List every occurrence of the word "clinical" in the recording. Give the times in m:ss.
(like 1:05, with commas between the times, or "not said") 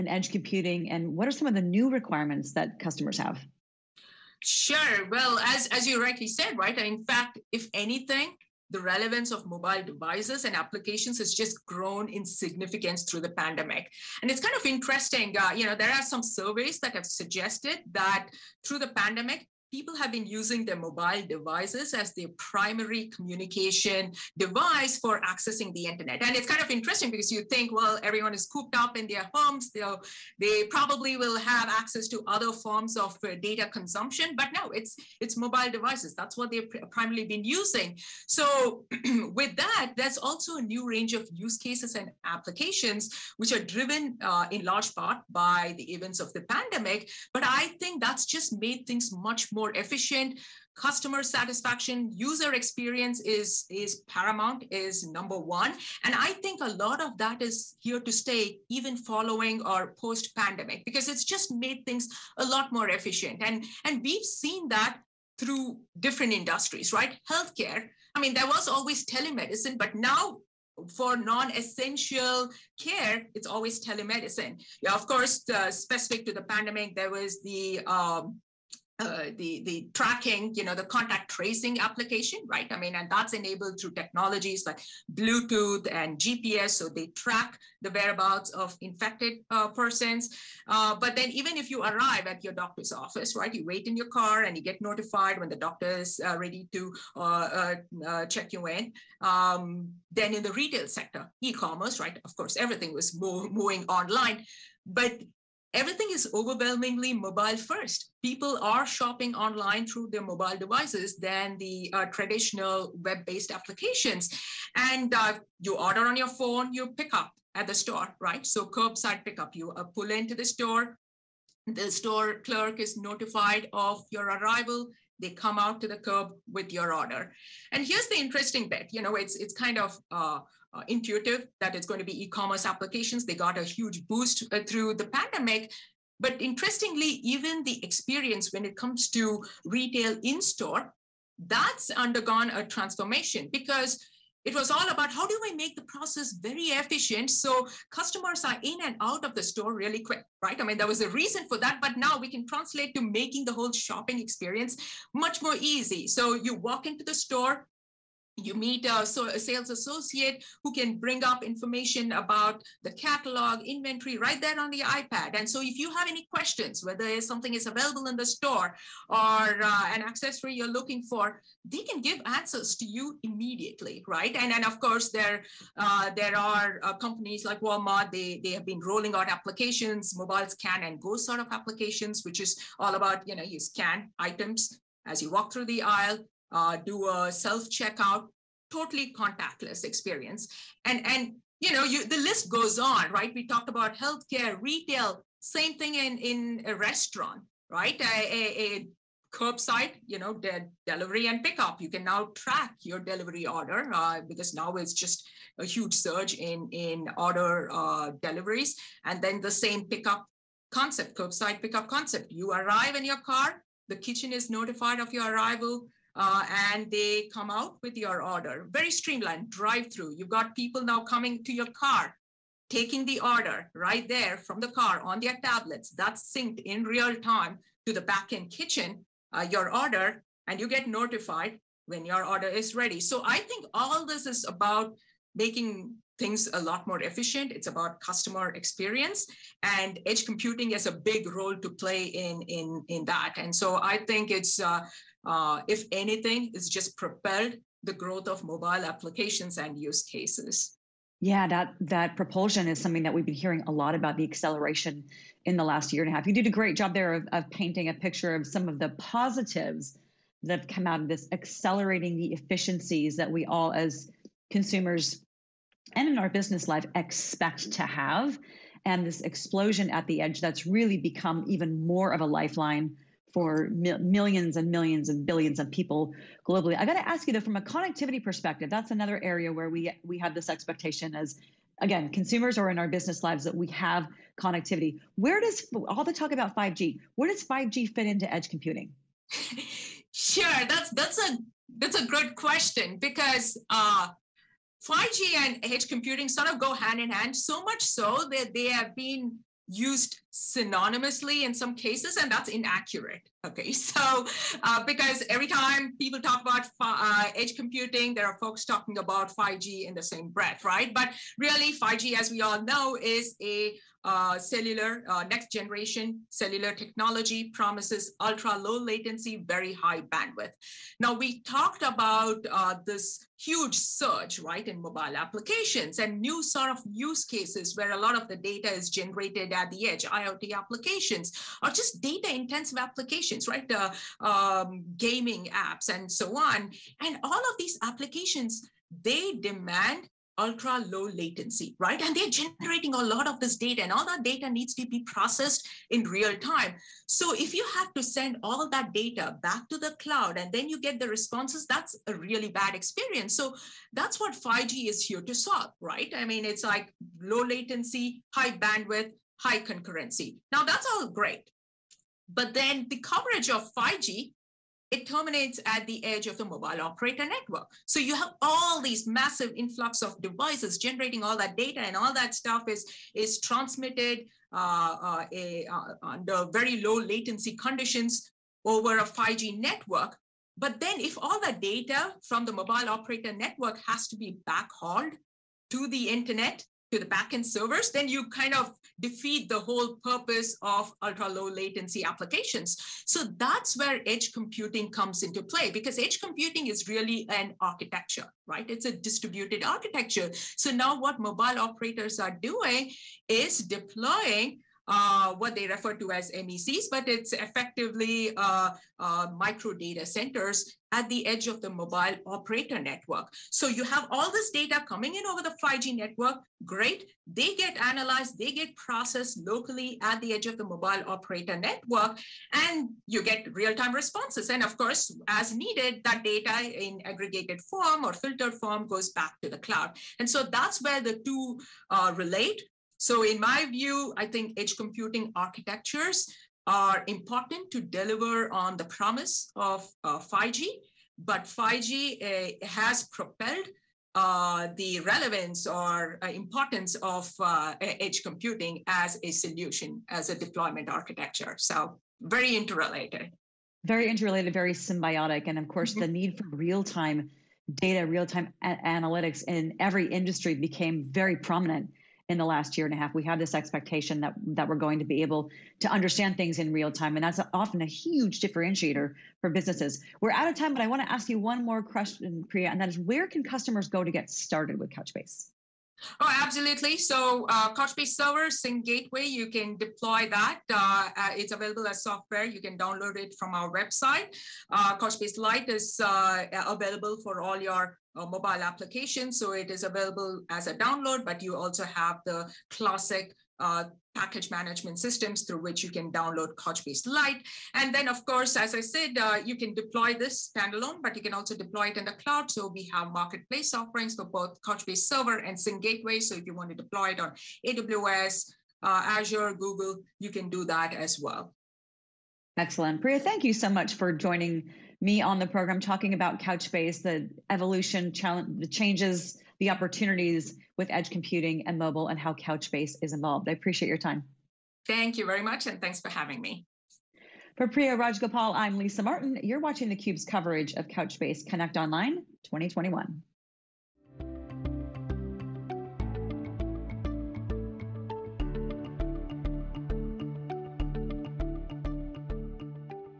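not said.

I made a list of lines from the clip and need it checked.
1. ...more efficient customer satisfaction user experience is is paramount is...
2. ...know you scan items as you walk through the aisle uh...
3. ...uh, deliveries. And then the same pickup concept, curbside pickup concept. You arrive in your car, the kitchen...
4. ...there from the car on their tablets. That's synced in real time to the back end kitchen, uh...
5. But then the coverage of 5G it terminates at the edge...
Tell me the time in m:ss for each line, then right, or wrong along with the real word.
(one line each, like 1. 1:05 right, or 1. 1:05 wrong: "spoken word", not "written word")
1. 0:49 right
2. 3:03 right
3. 3:27 right
4. 3:44 right
5. 6:02 right.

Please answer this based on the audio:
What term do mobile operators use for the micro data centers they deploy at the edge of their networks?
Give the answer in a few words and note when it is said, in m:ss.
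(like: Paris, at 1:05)
MECs, at 6:46.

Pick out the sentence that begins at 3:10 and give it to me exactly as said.
And, and you know, you, the list goes on, right?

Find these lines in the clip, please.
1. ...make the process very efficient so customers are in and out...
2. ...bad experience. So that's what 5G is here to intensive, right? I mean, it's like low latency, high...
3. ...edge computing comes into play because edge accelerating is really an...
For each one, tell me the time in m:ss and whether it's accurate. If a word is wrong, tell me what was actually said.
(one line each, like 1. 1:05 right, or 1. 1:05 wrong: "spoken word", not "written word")
1. 2:25 right
2. 5:52 wrong: "solve", not "intensive"
3. 6:34 wrong: "computing", not "accelerating".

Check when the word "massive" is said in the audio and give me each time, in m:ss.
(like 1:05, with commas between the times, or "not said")
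6:09.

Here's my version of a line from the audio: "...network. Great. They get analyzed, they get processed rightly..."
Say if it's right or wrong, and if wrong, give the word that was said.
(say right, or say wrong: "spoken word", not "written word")
wrong: "locally", not "rightly".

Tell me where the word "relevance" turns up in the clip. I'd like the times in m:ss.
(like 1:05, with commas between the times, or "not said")
0:08, 7:24.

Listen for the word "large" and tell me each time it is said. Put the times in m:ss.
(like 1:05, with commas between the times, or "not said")
0:44.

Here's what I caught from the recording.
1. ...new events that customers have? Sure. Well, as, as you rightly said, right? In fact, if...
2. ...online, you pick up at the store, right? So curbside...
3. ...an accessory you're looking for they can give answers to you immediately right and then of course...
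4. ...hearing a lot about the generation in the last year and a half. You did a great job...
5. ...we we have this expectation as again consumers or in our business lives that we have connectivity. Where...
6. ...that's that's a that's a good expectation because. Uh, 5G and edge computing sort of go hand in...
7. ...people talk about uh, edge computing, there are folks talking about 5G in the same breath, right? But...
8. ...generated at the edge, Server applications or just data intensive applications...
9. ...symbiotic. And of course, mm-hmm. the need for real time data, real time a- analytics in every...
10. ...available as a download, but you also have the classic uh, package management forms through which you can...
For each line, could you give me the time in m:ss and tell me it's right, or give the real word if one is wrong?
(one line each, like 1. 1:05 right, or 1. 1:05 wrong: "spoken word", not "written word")
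1. 0:01 wrong: "requirements", not "events"
2. 1:56 wrong: "phone", not "online"
3. 2:49 right
4. 4:13 wrong: "acceleration", not "generation"
5. 4:39 right
6. 4:50 wrong: "question", not "expectation"
7. 5:05 right
8. 5:28 wrong: "IoT", not "Server"
9. 7:34 right
10. 8:09 wrong: "systems", not "forms".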